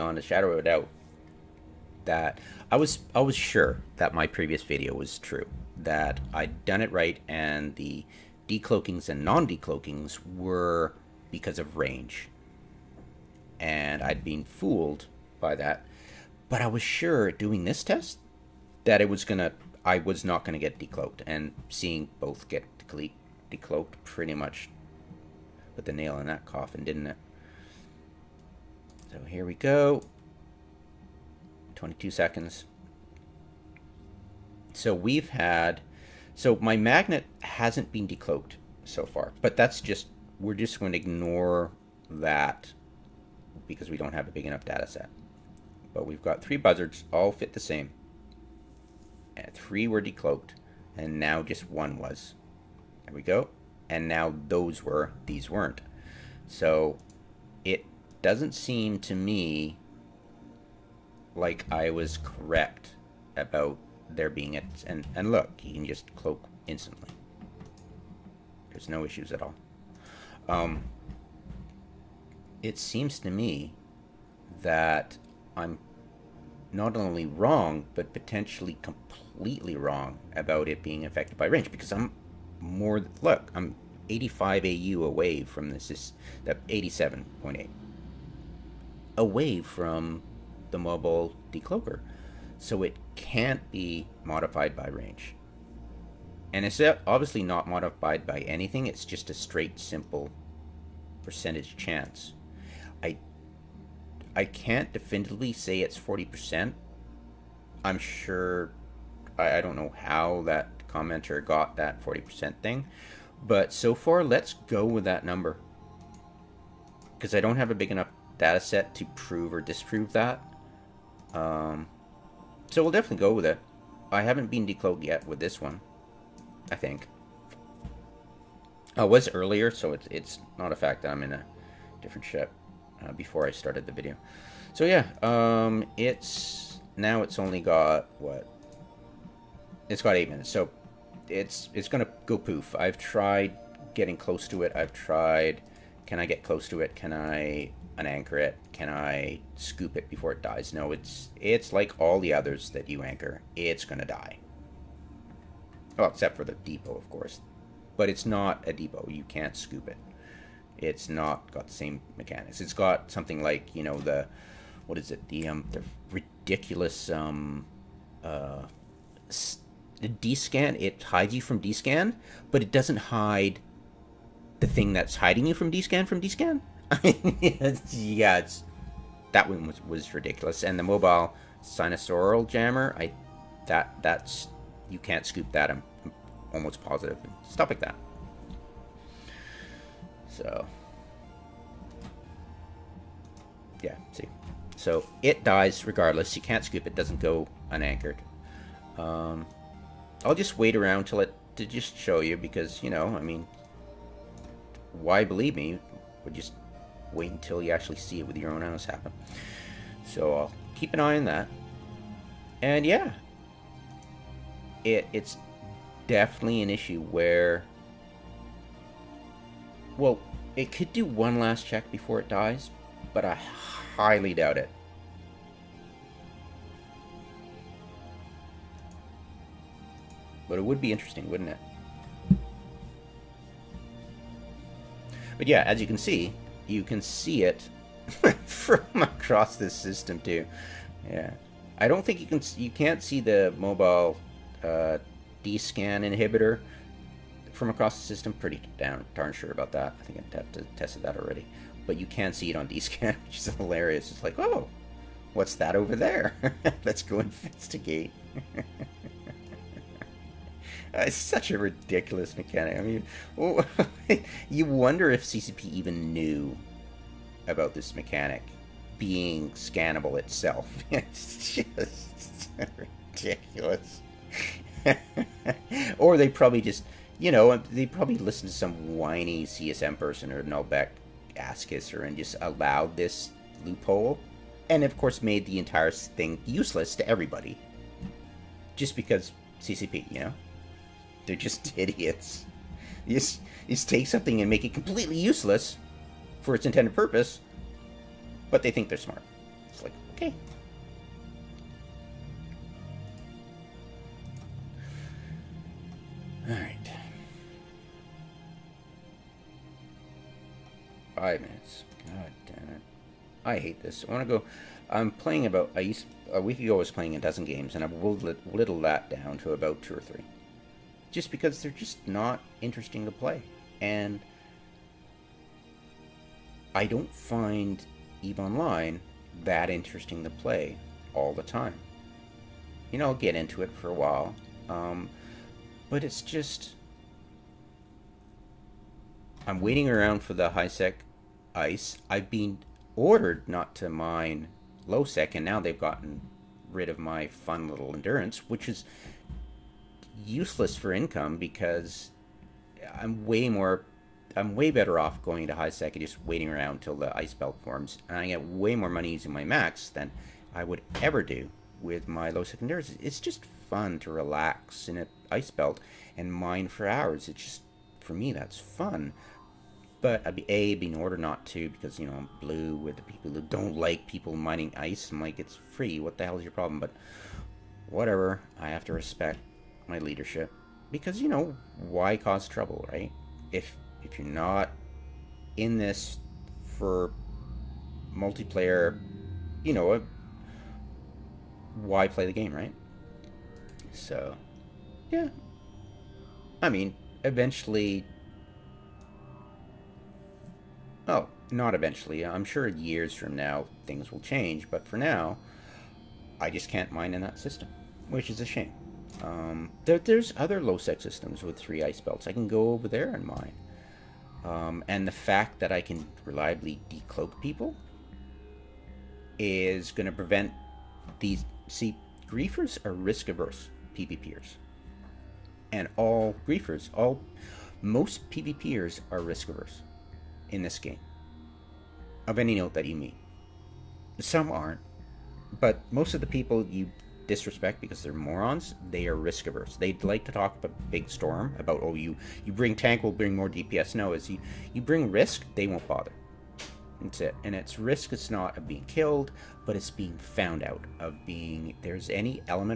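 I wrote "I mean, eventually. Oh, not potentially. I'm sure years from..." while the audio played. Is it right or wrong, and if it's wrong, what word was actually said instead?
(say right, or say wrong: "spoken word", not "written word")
wrong: "eventually", not "potentially".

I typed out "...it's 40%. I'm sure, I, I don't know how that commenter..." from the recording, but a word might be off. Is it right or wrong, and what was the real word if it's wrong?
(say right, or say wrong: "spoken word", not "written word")
right.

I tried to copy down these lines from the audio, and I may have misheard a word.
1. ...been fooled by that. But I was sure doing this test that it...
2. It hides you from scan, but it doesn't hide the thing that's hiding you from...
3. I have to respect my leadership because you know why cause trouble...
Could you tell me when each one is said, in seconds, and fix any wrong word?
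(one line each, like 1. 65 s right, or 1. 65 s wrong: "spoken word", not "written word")
1. 14 s right
2. 170 s right
3. 378 s right.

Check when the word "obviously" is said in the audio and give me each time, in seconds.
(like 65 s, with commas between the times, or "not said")
97 s.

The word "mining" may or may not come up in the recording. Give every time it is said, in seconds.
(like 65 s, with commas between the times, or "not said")
374 s.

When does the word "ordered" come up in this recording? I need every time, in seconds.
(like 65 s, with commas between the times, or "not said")
342 s, 370 s.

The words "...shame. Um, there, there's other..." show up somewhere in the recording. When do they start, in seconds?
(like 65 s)
408 s.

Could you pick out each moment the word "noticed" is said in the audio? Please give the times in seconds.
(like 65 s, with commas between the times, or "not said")
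not said.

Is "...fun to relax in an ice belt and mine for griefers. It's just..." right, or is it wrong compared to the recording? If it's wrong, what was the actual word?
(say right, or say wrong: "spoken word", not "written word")
wrong: "hours", not "griefers".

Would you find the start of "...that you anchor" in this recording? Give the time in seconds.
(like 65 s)
152 s.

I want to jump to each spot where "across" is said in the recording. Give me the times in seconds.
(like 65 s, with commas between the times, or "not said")
238 s, 247 s.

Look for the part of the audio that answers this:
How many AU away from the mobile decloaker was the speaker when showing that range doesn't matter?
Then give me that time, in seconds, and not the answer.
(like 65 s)
86 s.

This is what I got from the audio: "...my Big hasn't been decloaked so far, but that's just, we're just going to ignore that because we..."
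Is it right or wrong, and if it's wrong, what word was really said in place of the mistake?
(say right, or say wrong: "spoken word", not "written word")
wrong: "Magnate", not "Big".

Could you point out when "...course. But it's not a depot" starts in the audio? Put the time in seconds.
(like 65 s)
157 s.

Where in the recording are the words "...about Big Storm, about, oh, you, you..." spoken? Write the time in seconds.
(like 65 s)
440 s.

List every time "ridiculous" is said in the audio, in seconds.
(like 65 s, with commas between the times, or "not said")
166 s, 180 s, 261 s, 273 s.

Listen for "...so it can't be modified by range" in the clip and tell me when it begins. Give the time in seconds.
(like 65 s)
92 s.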